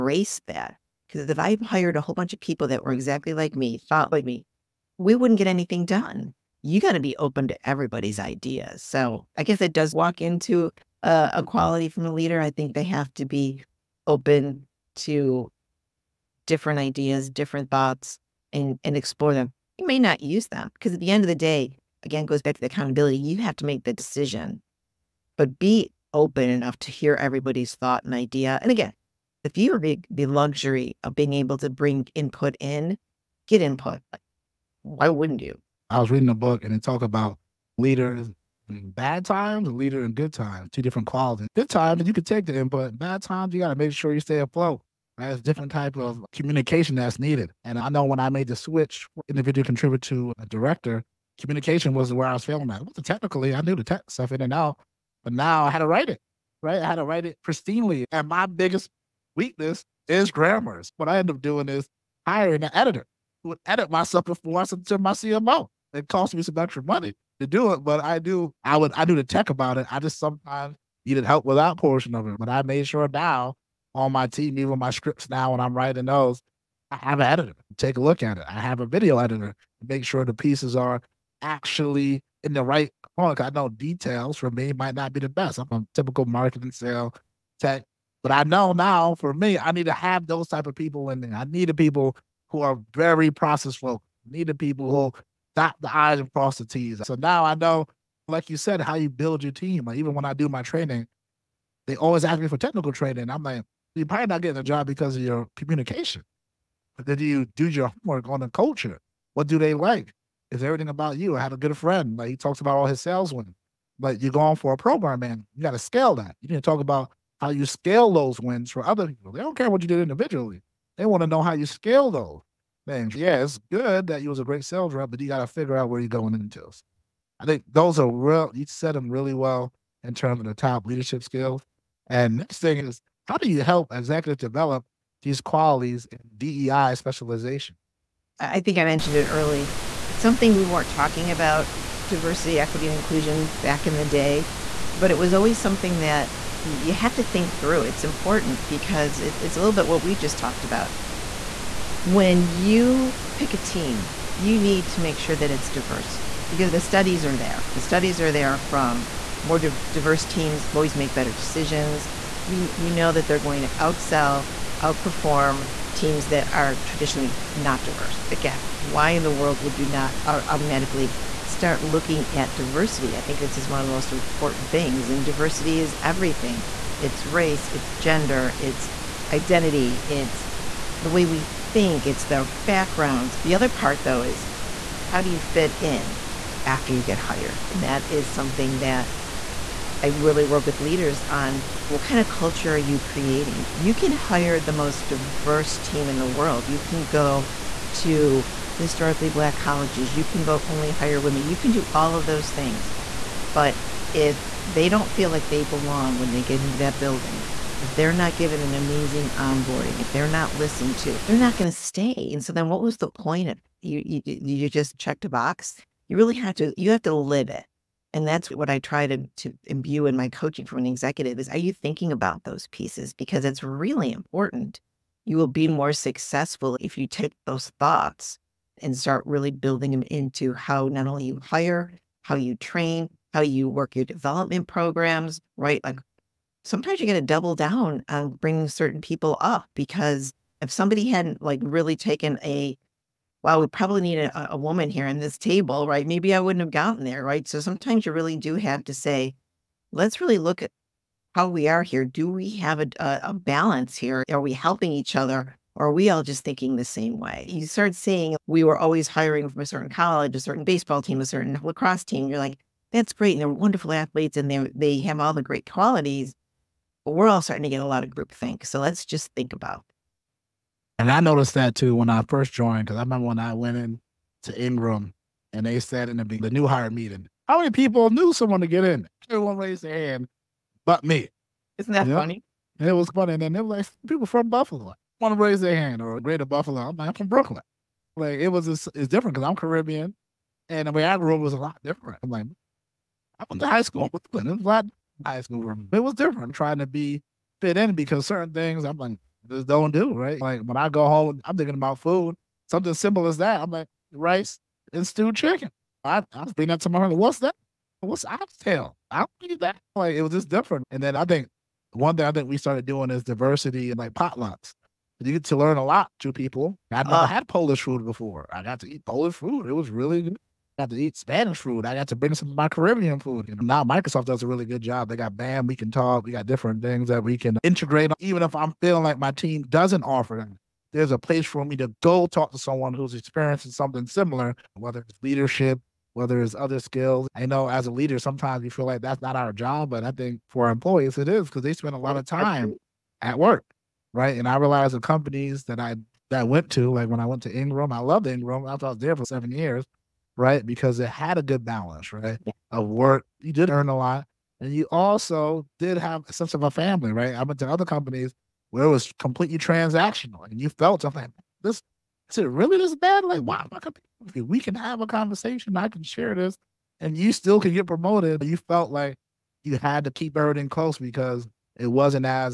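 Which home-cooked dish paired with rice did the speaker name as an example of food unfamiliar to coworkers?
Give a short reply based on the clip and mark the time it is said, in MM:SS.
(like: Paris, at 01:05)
Stewed chicken, at 05:05.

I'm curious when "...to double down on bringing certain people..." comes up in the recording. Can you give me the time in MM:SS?
03:57.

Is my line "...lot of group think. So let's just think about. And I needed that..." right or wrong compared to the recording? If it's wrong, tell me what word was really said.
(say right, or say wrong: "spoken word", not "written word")
wrong: "noticed", not "needed".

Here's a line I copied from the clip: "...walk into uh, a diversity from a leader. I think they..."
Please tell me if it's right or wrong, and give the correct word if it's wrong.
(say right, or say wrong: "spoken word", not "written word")
wrong: "quality", not "diversity".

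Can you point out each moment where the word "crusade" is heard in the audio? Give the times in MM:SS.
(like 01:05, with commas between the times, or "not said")
not said.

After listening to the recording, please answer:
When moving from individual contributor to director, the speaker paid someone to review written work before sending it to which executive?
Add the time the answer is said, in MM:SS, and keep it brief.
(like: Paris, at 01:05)
CMO, at 01:05.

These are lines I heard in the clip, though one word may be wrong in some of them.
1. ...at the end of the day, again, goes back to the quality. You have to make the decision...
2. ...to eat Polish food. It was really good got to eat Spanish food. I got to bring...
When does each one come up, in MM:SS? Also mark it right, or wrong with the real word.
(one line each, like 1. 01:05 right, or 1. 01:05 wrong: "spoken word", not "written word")
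1. 00:20 wrong: "accountability", not "quality"
2. 05:18 right.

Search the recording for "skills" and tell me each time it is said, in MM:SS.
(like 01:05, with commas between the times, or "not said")
02:11, 05:36.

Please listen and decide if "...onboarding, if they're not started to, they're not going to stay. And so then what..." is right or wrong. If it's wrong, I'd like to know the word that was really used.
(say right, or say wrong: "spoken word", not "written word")
wrong: "listened", not "started".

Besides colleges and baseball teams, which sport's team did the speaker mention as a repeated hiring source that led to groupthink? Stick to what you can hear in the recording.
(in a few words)
Lacrosse.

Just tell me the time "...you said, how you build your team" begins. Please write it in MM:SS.
01:38.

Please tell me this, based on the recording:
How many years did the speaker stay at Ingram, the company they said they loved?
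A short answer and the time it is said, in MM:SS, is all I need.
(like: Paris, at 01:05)
7, at 05:49.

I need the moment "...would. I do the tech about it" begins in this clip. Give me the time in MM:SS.
01:08.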